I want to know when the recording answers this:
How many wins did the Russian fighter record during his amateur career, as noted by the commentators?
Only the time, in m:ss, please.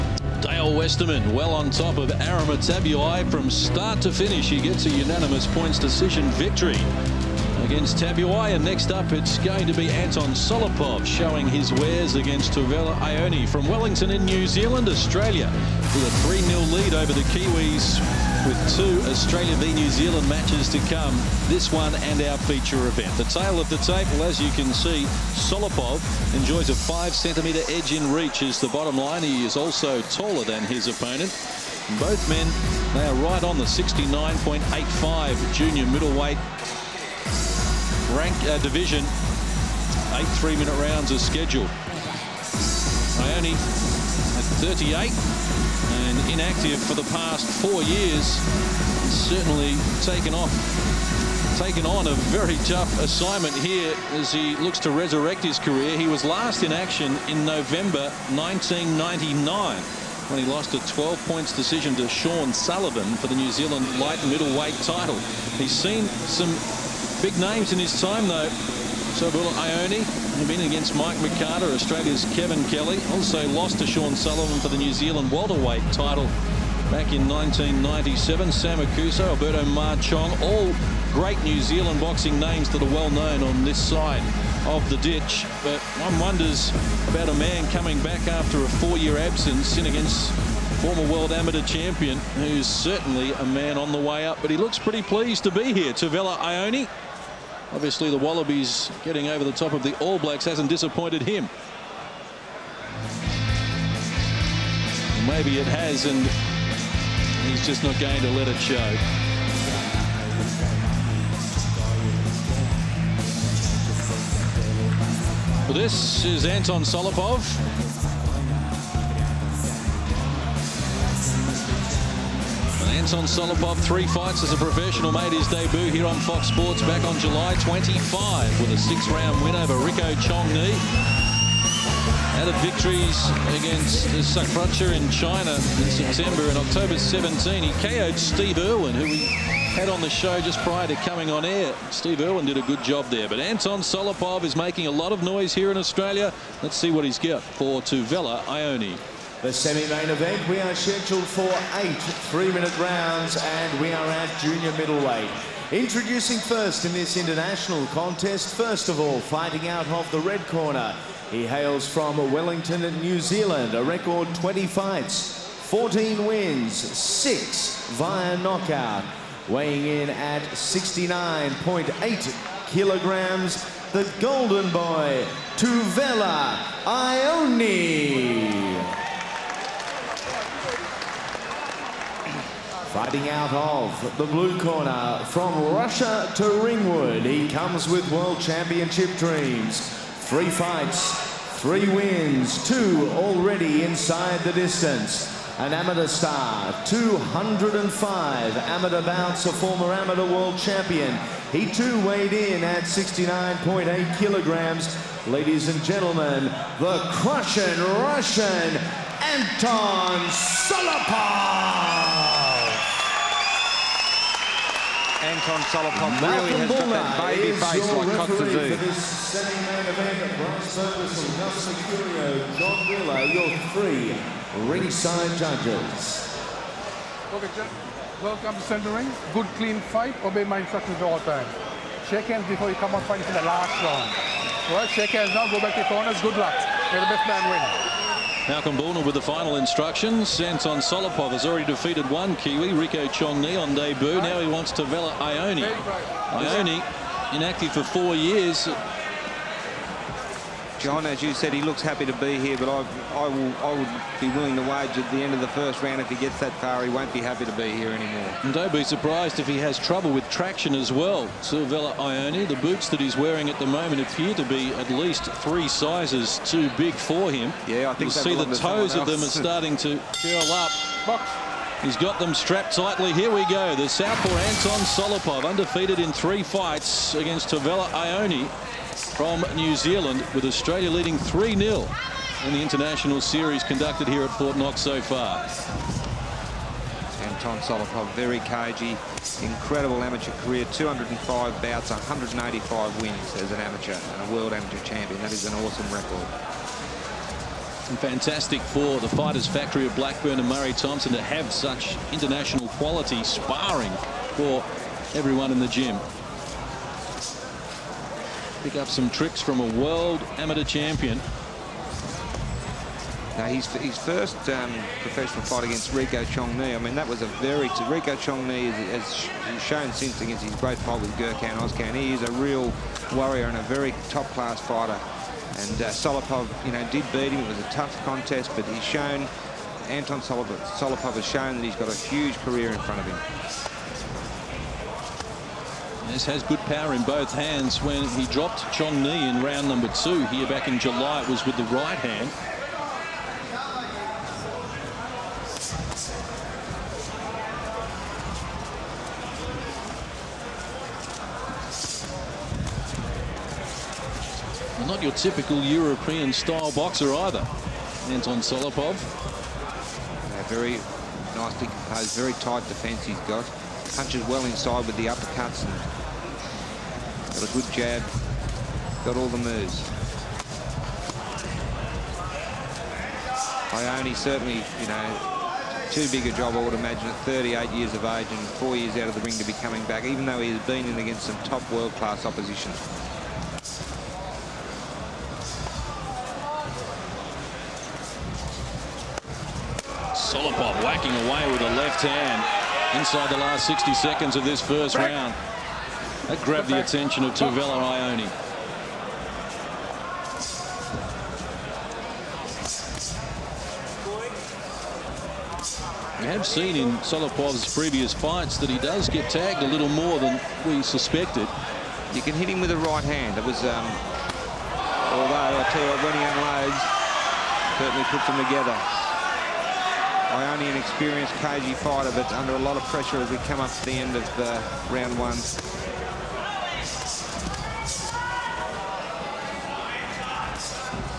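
4:51.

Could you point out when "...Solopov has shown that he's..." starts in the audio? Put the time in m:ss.
5:30.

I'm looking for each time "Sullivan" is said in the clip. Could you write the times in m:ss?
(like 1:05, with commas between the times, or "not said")
1:02, 1:14.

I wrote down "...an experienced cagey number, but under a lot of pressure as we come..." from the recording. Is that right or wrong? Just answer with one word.
wrong.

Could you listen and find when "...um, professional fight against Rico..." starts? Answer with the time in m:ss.
5:14.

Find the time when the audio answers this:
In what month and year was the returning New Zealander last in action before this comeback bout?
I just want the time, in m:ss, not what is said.
0:57.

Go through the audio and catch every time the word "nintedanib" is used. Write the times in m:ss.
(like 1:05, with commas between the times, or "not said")
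not said.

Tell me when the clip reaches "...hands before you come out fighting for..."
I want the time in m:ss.
3:52.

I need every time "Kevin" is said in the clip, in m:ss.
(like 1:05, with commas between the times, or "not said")
1:12.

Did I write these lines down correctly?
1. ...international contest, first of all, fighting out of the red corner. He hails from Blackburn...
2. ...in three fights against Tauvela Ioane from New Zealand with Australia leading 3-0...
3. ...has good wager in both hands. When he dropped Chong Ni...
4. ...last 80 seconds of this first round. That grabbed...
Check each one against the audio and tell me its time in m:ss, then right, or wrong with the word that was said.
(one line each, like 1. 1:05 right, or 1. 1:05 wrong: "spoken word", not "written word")
1. 2:37 wrong: "Wellington", not "Blackburn"
2. 4:35 right
3. 5:36 wrong: "power", not "wager"
4. 6:33 wrong: "60", not "80".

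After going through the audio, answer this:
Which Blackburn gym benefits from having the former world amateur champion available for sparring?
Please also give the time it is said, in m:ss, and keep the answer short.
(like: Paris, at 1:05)
Fighters Factory, at 4:59.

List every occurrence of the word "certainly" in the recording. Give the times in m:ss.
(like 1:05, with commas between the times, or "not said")
0:49, 1:32, 6:14, 6:57.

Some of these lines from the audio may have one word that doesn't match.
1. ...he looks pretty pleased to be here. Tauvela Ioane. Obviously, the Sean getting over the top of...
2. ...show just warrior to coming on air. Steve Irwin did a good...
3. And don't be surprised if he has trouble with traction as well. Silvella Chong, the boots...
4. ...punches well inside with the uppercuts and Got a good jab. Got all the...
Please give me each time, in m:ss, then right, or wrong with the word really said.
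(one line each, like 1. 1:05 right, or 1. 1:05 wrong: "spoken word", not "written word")
1. 1:34 wrong: "Wallabies", not "Sean"
2. 2:20 wrong: "prior", not "warrior"
3. 4:18 wrong: "Ioane", not "Chong"
4. 6:03 right.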